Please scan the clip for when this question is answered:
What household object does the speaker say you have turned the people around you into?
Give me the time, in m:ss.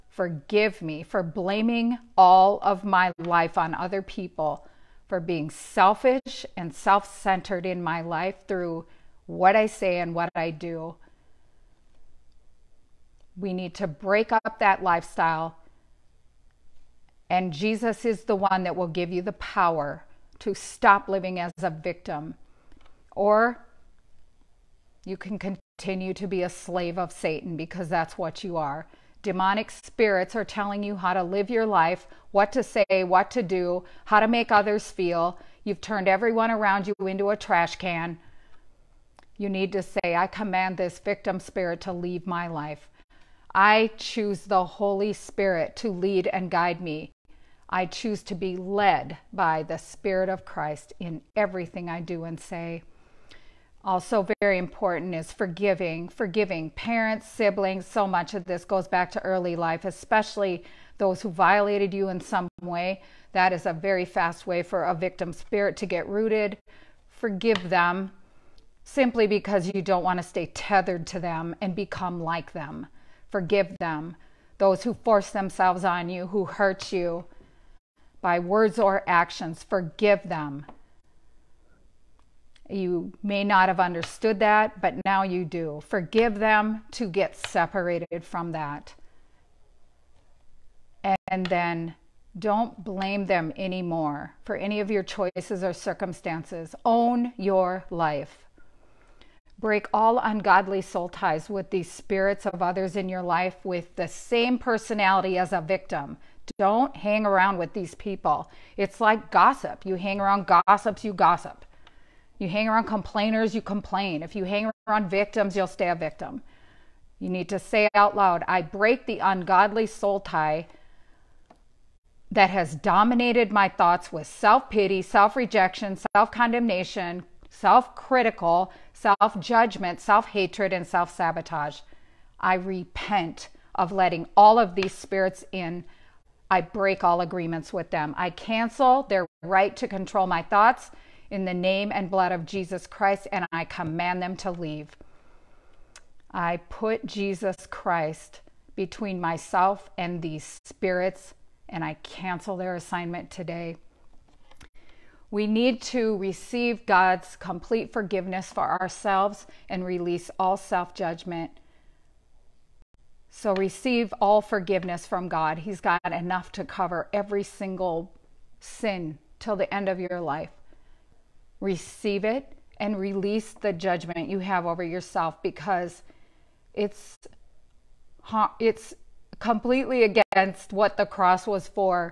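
0:37.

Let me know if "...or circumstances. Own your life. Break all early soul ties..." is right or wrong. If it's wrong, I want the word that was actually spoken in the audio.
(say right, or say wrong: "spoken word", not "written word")
wrong: "ungodly", not "early".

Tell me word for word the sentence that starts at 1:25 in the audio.
Forgive them to get separated from that.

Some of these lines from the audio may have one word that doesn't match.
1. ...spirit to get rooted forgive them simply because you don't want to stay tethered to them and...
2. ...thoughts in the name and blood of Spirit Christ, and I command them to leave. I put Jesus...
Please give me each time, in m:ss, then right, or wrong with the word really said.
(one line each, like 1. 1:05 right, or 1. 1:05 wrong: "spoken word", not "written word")
1. 1:05 right
2. 2:20 wrong: "Jesus", not "Spirit".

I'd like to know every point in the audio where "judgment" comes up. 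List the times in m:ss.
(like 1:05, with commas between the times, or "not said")
2:09, 2:40, 2:53.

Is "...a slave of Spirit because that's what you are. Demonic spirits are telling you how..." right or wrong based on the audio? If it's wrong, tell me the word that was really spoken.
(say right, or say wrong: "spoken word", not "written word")
wrong: "Satan", not "Spirit".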